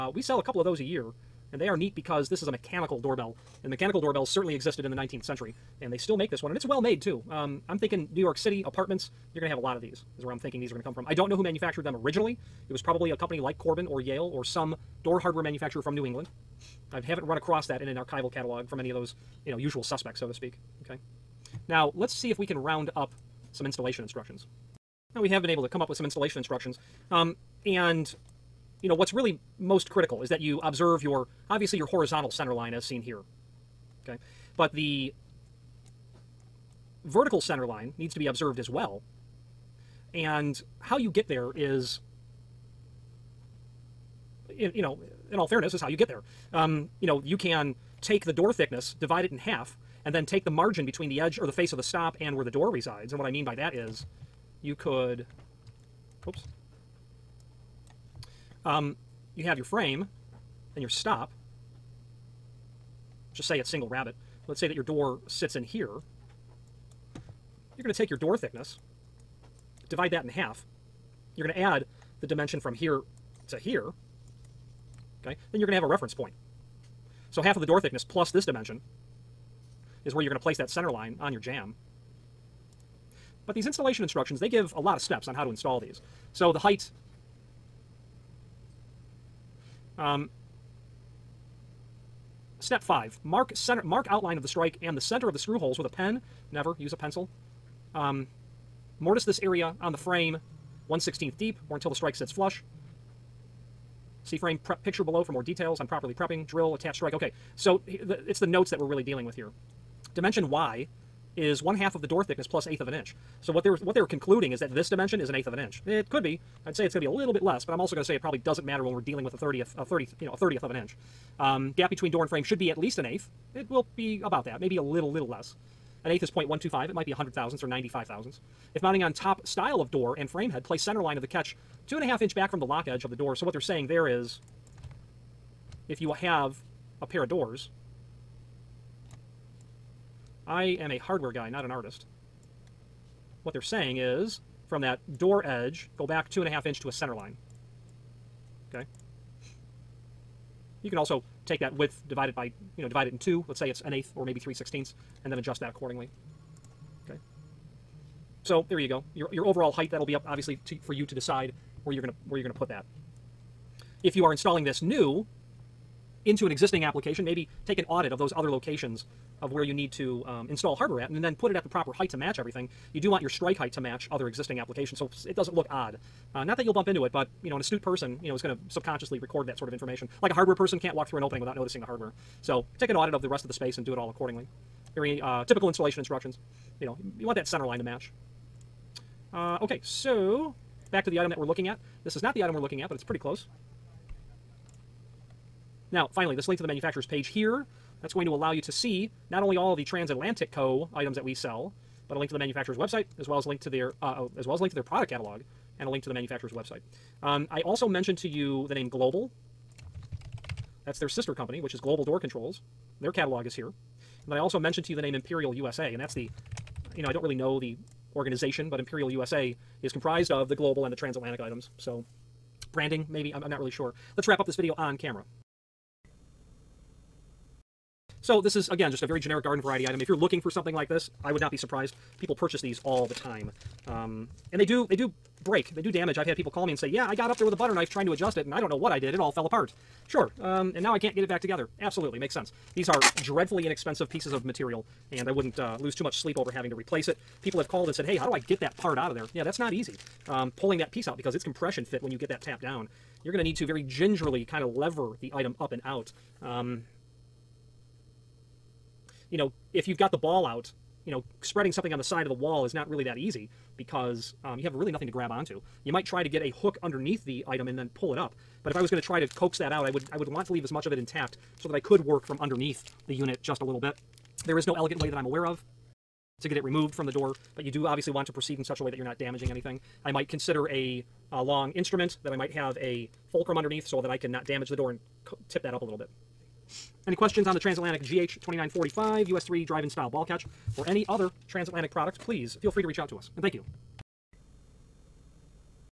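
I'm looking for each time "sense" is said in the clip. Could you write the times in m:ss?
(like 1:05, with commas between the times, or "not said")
4:02.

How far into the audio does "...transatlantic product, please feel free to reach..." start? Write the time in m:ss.
4:51.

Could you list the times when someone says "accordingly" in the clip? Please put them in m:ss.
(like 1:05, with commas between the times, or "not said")
2:35, 3:04.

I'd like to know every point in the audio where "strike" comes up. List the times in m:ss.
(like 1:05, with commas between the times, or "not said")
1:34, 1:41, 1:46, 2:53.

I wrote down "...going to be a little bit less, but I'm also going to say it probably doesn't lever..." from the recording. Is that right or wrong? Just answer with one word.
wrong.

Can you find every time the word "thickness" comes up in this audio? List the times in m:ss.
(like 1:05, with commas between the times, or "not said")
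0:48, 1:08, 1:17, 1:52.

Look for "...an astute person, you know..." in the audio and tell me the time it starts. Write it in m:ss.
2:57.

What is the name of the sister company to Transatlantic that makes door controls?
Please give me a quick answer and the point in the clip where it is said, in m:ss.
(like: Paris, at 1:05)
Global Door Controls, at 3:31.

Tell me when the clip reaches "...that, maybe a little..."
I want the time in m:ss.
2:04.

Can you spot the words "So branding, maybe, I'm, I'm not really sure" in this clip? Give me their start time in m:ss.
3:41.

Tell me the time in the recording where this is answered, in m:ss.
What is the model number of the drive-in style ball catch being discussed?
4:48.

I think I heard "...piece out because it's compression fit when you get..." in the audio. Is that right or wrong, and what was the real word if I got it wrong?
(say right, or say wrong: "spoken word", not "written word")
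right.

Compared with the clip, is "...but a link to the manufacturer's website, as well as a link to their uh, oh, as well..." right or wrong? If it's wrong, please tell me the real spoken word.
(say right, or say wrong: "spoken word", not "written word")
right.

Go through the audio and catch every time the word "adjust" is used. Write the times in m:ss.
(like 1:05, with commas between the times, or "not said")
2:35, 3:58.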